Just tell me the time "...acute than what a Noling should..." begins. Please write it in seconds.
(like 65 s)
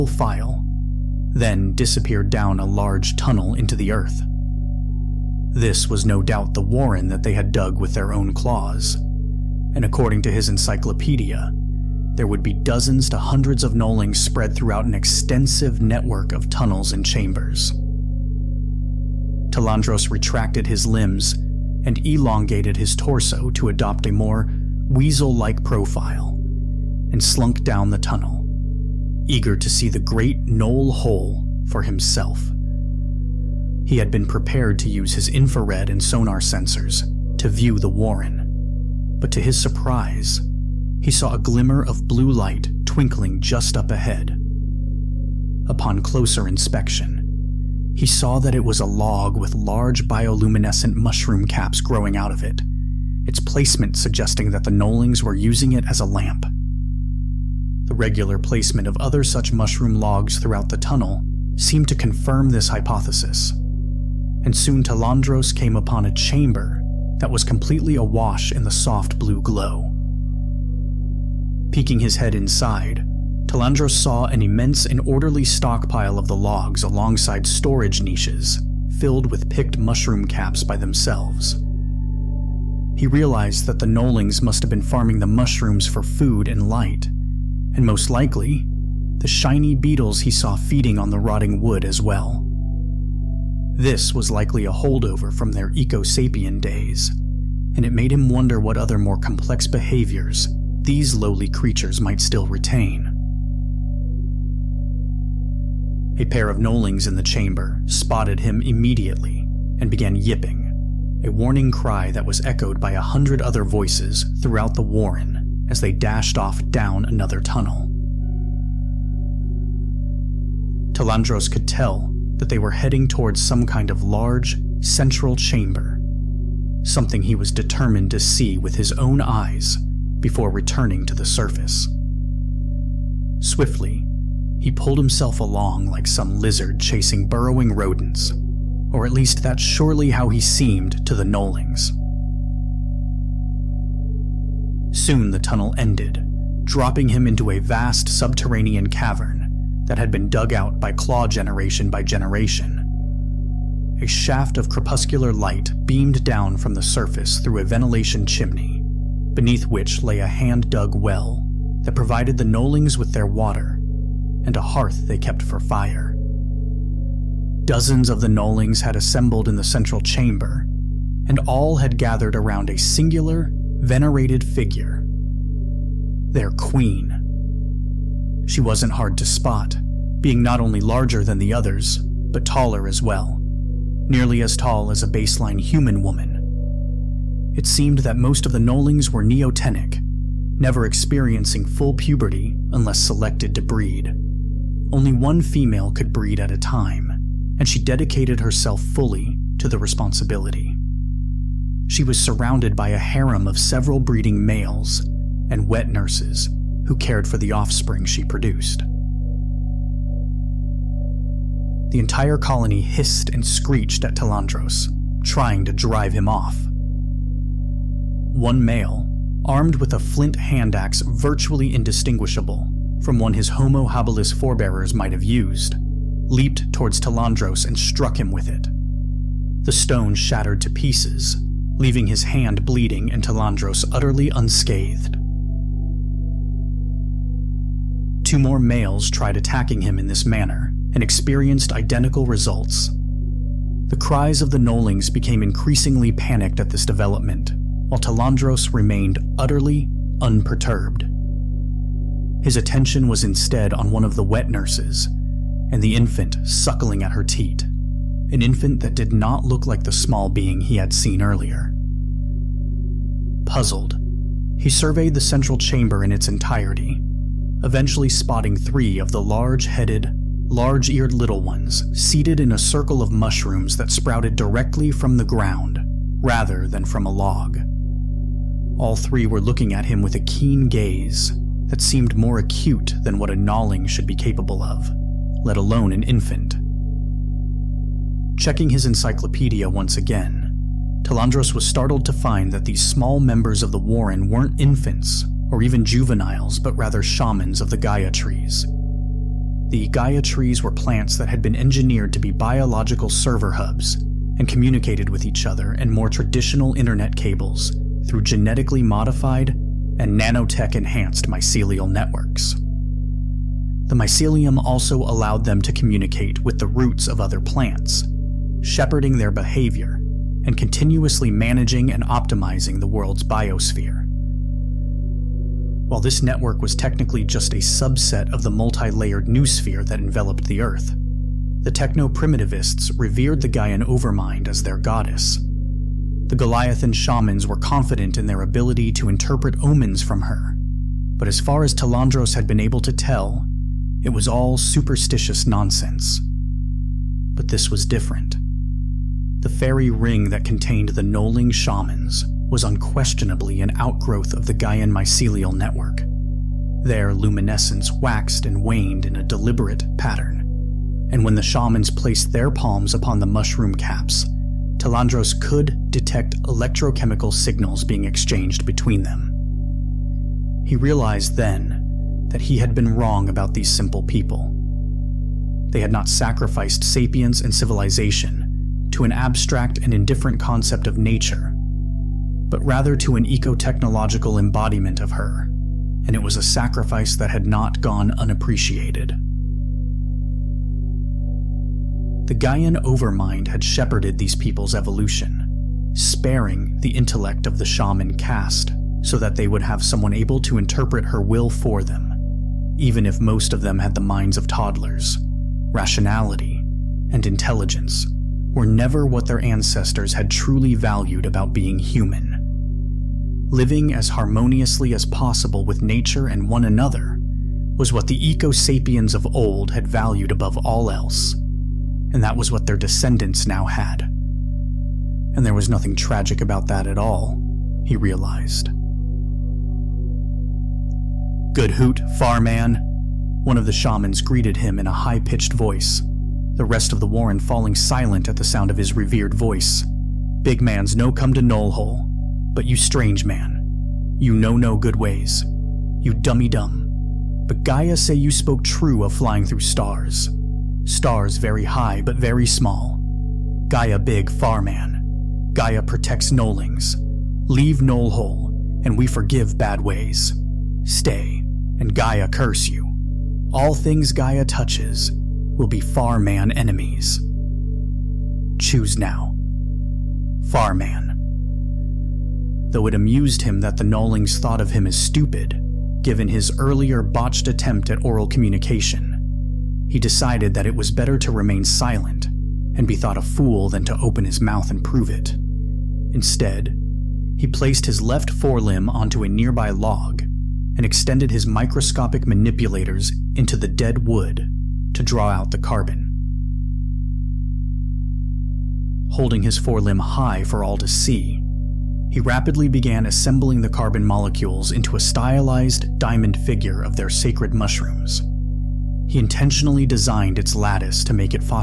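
282 s.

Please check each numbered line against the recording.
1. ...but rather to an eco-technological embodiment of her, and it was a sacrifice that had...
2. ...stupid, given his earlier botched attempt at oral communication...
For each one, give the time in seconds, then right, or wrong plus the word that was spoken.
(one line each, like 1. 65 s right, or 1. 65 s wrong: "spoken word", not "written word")
1. 382 s right
2. 474 s right.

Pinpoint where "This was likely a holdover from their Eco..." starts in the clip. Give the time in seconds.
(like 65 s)
93 s.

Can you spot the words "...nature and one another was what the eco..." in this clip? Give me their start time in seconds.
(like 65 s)
415 s.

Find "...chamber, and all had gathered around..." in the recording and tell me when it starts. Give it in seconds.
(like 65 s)
169 s.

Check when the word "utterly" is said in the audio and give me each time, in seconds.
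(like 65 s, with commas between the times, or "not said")
233 s, 249 s.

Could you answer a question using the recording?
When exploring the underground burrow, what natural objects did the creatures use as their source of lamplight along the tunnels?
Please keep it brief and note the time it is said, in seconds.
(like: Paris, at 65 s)
bioluminescent mushroom caps, at 50 s.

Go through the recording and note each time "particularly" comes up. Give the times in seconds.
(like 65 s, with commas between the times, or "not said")
not said.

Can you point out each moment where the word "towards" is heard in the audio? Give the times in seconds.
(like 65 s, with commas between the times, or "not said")
123 s, 226 s.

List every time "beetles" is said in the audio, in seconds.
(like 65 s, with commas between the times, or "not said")
89 s.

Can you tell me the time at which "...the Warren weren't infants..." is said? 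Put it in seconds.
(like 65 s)
293 s.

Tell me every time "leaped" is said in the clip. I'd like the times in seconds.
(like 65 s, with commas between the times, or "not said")
226 s.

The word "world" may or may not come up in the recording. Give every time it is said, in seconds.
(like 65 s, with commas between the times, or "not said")
322 s.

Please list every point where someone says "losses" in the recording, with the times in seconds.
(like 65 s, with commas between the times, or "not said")
not said.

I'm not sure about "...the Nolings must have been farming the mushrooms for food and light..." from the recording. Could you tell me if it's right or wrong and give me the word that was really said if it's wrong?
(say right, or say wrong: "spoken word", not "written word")
right.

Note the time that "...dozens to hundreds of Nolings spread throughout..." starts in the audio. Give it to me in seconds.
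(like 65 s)
12 s.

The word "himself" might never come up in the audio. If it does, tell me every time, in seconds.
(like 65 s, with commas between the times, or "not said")
31 s, 134 s.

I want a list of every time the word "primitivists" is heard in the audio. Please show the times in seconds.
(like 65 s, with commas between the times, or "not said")
331 s.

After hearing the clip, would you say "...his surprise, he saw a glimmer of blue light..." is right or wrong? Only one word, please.
right.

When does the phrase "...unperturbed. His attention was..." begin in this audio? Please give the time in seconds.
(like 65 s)
250 s.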